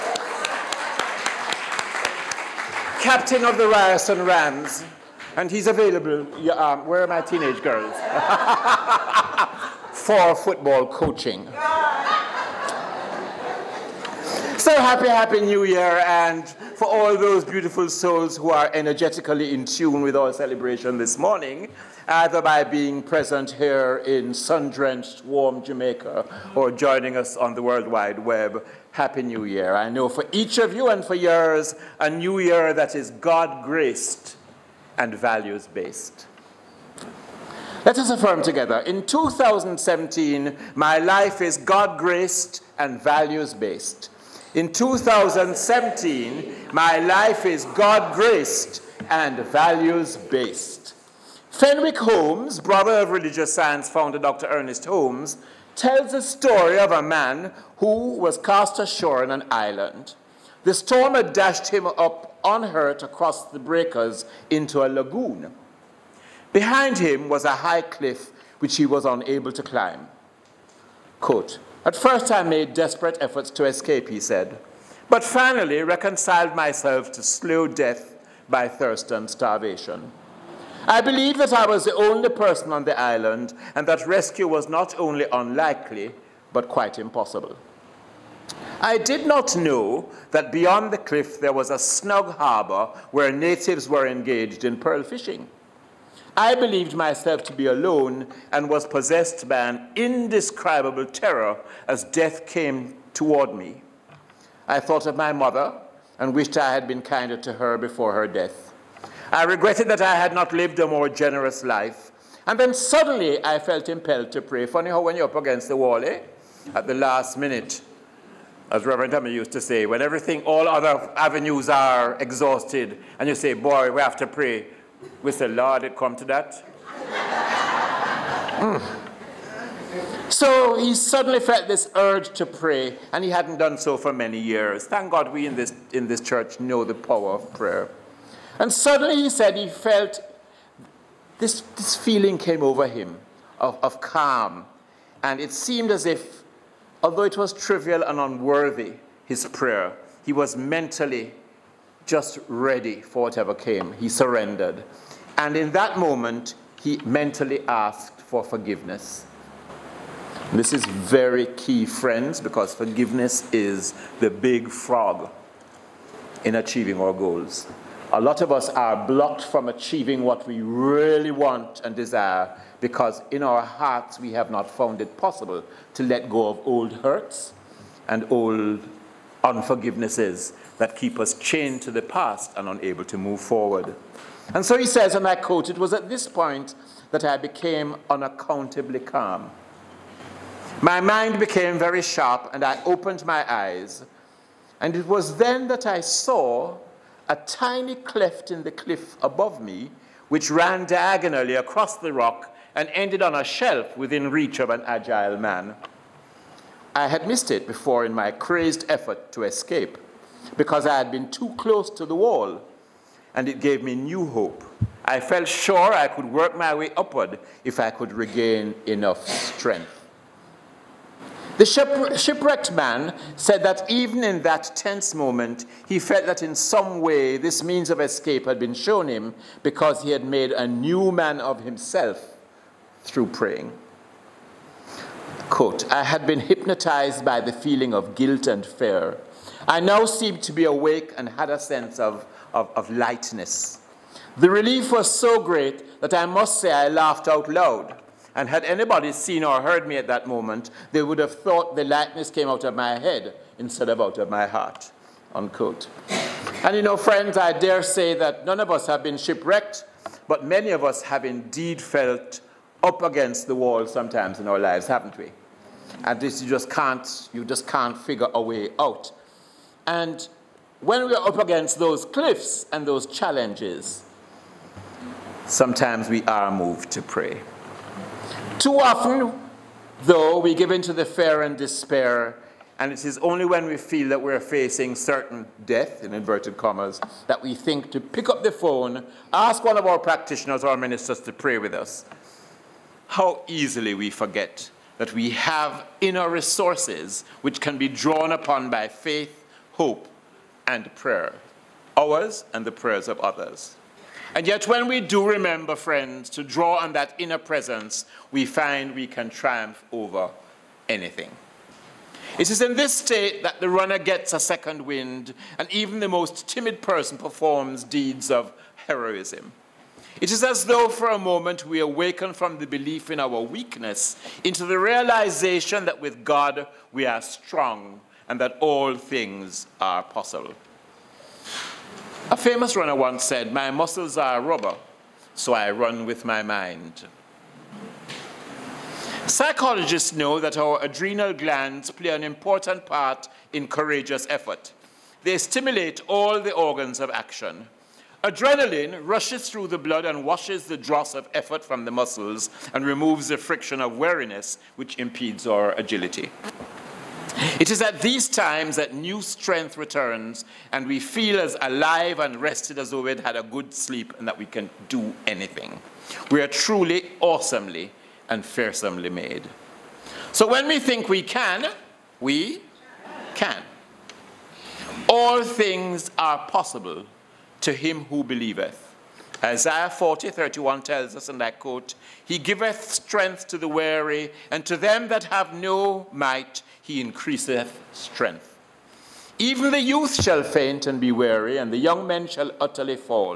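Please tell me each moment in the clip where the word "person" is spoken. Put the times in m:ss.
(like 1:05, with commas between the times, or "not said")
1:22, 5:16.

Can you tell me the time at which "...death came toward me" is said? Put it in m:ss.
1:42.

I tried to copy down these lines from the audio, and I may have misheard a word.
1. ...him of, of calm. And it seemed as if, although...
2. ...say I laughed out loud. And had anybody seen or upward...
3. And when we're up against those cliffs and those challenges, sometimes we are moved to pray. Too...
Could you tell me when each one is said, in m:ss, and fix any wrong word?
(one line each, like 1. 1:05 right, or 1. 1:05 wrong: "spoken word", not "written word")
1. 2:22 right
2. 4:06 wrong: "heard", not "upward"
3. 4:29 right.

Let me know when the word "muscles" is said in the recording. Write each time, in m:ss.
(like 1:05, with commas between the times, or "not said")
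5:33, 5:51.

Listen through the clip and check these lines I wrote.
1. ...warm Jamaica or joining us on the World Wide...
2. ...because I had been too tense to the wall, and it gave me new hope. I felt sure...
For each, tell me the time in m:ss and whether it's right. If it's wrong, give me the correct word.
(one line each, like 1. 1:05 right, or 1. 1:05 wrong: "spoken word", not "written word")
1. 0:25 right
2. 3:30 wrong: "close", not "tense".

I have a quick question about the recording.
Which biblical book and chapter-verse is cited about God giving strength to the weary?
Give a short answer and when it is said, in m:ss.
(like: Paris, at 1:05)
Isaiah 40:31, at 6:19.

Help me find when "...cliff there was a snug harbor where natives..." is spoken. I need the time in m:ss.
1:30.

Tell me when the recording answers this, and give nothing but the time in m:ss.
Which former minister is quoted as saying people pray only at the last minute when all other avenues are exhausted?
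1:58.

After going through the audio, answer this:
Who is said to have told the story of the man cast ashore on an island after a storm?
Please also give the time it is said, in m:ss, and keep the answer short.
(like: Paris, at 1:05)
Fenwick Holmes, at 0:51.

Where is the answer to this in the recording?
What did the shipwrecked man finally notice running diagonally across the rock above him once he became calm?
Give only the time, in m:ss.
3:17.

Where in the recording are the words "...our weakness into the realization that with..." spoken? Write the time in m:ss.
5:23.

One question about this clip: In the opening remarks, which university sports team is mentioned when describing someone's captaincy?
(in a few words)
Ryerson Rams.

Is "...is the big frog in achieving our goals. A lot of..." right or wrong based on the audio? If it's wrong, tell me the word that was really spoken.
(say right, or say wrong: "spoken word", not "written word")
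right.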